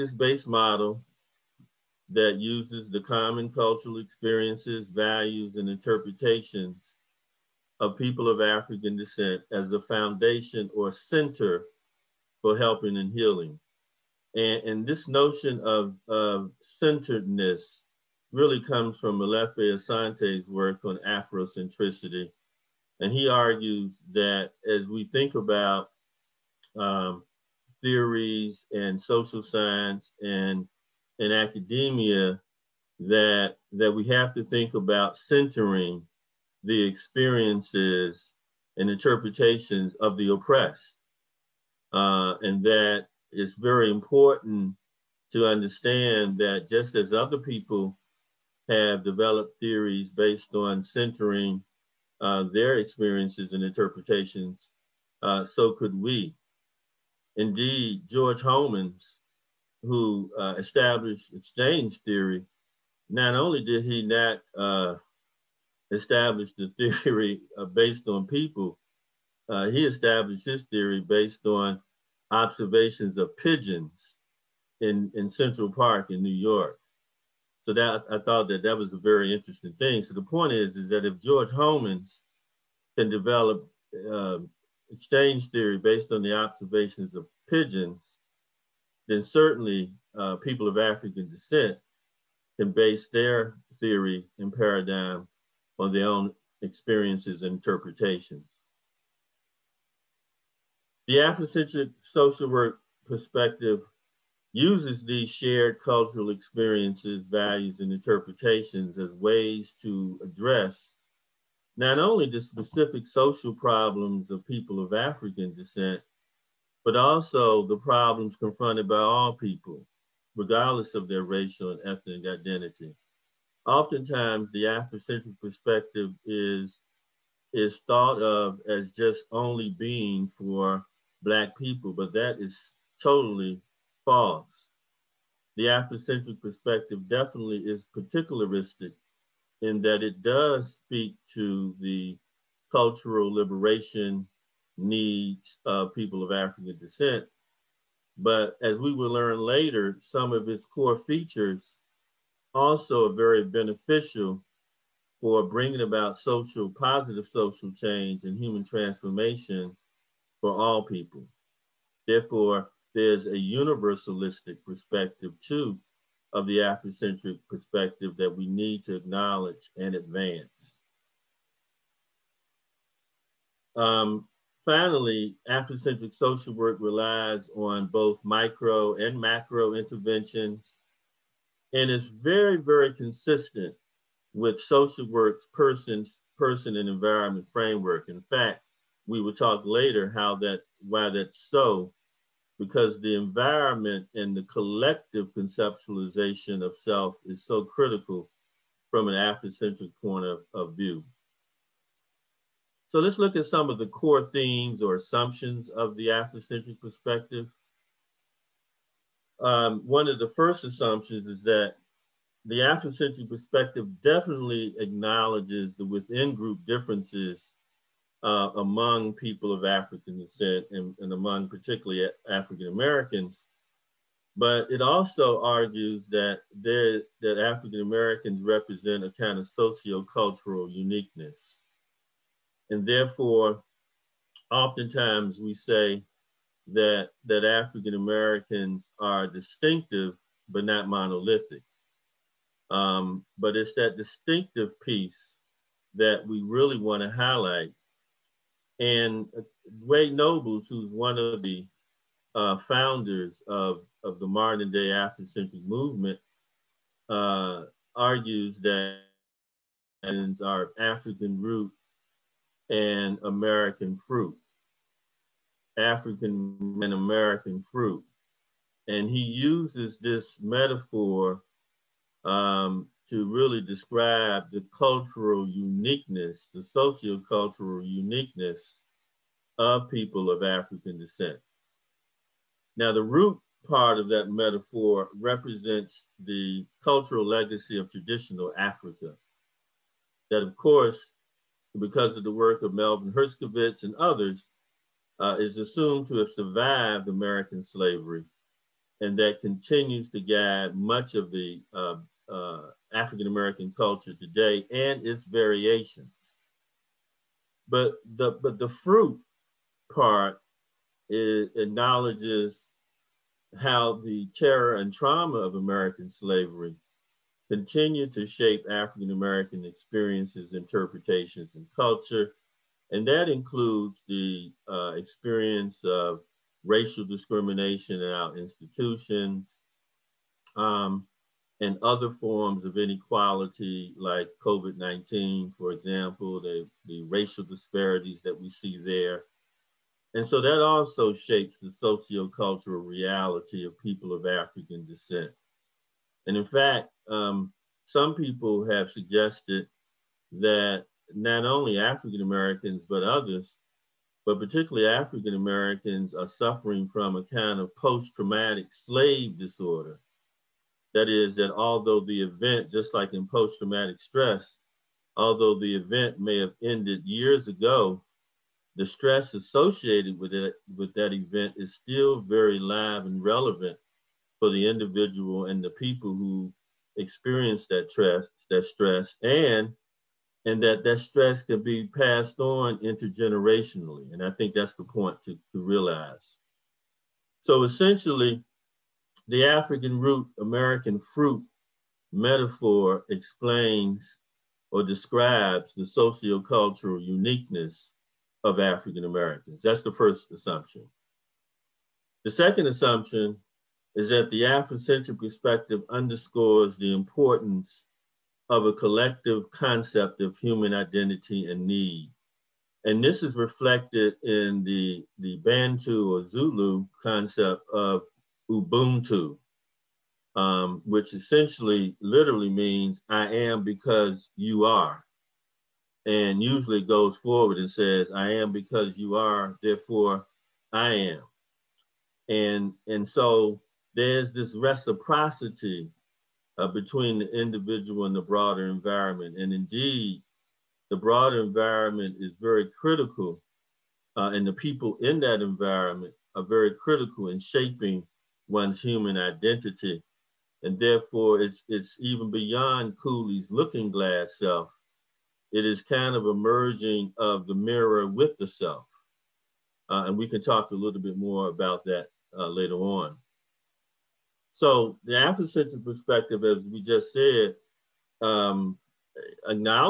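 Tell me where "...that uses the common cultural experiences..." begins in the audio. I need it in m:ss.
0:02.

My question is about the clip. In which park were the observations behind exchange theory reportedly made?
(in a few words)
Central Park.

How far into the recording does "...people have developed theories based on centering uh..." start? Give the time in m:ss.
0:47.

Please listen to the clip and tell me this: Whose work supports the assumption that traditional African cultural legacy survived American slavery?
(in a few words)
Melvin Herskovits.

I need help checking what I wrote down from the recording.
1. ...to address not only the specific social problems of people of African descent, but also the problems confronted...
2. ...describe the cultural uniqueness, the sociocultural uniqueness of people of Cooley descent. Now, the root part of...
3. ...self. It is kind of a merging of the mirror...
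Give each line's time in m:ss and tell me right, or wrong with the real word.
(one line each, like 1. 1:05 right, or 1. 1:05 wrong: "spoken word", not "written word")
1. 1:49 right
2. 4:33 wrong: "African", not "Cooley"
3. 7:34 right.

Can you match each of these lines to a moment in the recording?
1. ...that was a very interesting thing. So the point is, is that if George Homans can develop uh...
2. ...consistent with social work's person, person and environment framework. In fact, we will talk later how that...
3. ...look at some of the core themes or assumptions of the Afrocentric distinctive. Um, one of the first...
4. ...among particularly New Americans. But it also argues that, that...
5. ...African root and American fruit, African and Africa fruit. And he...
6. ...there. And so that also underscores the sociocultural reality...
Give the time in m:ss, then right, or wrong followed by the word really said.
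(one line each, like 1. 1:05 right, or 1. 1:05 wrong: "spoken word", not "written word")
1. 1:18 right
2. 3:02 right
3. 3:23 wrong: "perspective", not "distinctive"
4. 3:41 wrong: "African", not "New"
5. 4:20 wrong: "American", not "Africa"
6. 5:38 wrong: "shapes", not "underscores".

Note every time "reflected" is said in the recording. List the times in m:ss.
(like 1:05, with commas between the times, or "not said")
6:53.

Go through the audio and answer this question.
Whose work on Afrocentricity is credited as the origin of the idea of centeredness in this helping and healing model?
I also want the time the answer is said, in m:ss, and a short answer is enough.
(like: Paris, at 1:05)
Molefi Asante, at 0:19.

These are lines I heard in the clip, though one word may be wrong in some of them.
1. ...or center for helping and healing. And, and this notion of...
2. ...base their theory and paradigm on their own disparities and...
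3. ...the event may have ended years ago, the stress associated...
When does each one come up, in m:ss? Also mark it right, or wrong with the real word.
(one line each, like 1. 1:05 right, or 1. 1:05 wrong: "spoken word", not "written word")
1. 0:10 right
2. 1:32 wrong: "experiences", not "disparities"
3. 6:05 right.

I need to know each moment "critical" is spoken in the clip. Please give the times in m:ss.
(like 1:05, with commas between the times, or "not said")
3:17, 7:22, 7:26.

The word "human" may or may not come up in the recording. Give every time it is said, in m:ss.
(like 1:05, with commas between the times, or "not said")
2:38, 6:50, 7:28.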